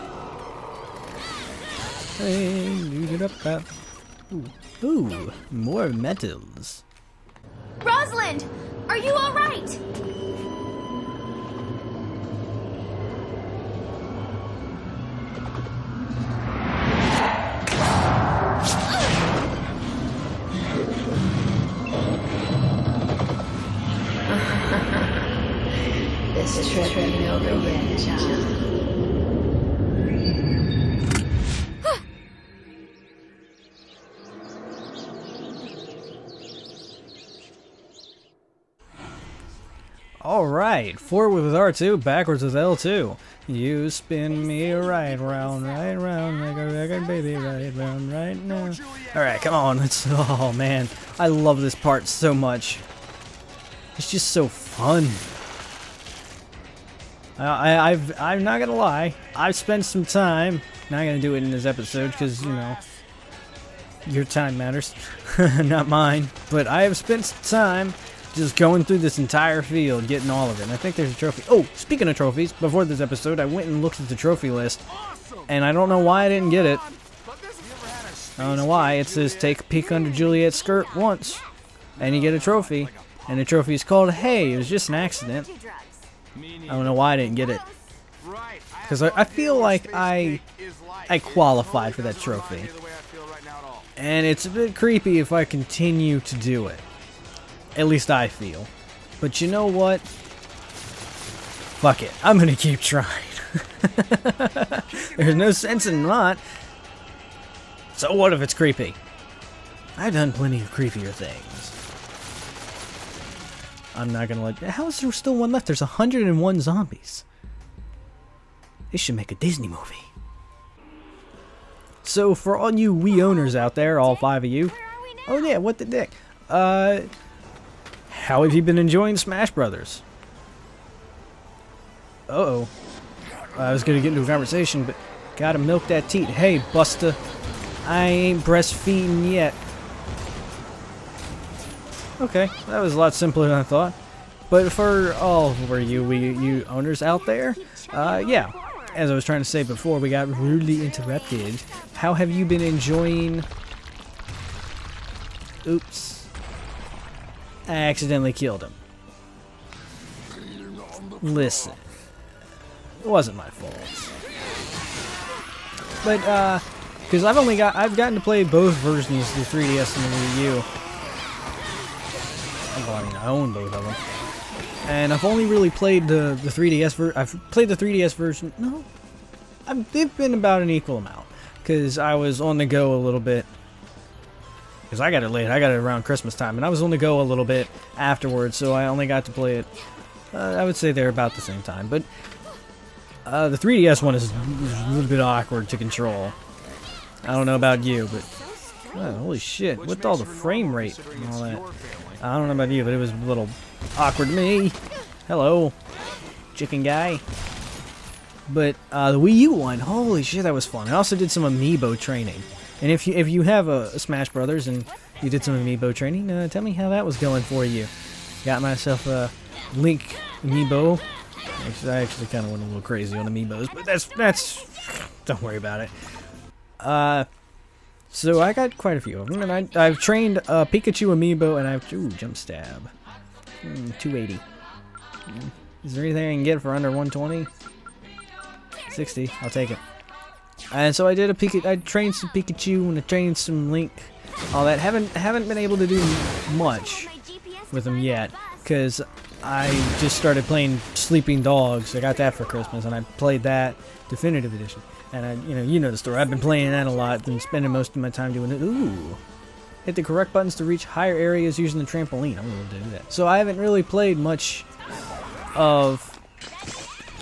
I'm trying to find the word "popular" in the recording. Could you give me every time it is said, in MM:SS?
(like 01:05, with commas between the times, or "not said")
not said.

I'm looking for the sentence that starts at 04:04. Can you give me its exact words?
Haven't haven't been able to do much with them yet, because I just started playing Sleeping Dogs.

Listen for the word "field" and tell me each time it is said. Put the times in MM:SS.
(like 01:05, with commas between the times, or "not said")
01:09.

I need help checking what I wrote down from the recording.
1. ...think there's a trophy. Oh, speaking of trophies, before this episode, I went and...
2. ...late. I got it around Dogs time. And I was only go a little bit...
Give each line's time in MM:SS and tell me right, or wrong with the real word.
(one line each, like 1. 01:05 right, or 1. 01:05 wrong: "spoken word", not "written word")
1. 01:10 right
2. 03:05 wrong: "Christmas", not "Dogs".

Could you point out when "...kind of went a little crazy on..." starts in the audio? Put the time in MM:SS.
03:42.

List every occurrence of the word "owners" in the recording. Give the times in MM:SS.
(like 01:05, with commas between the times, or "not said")
02:03, 02:26.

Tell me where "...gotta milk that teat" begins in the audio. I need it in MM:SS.
02:15.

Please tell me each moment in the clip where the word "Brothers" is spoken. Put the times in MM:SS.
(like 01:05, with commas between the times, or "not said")
02:09, 03:34.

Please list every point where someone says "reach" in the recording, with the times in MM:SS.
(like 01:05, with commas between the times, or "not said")
04:20.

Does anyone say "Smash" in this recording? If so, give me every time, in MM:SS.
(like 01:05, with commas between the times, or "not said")
02:09, 03:33.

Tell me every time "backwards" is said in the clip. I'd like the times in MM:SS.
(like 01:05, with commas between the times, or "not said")
00:42.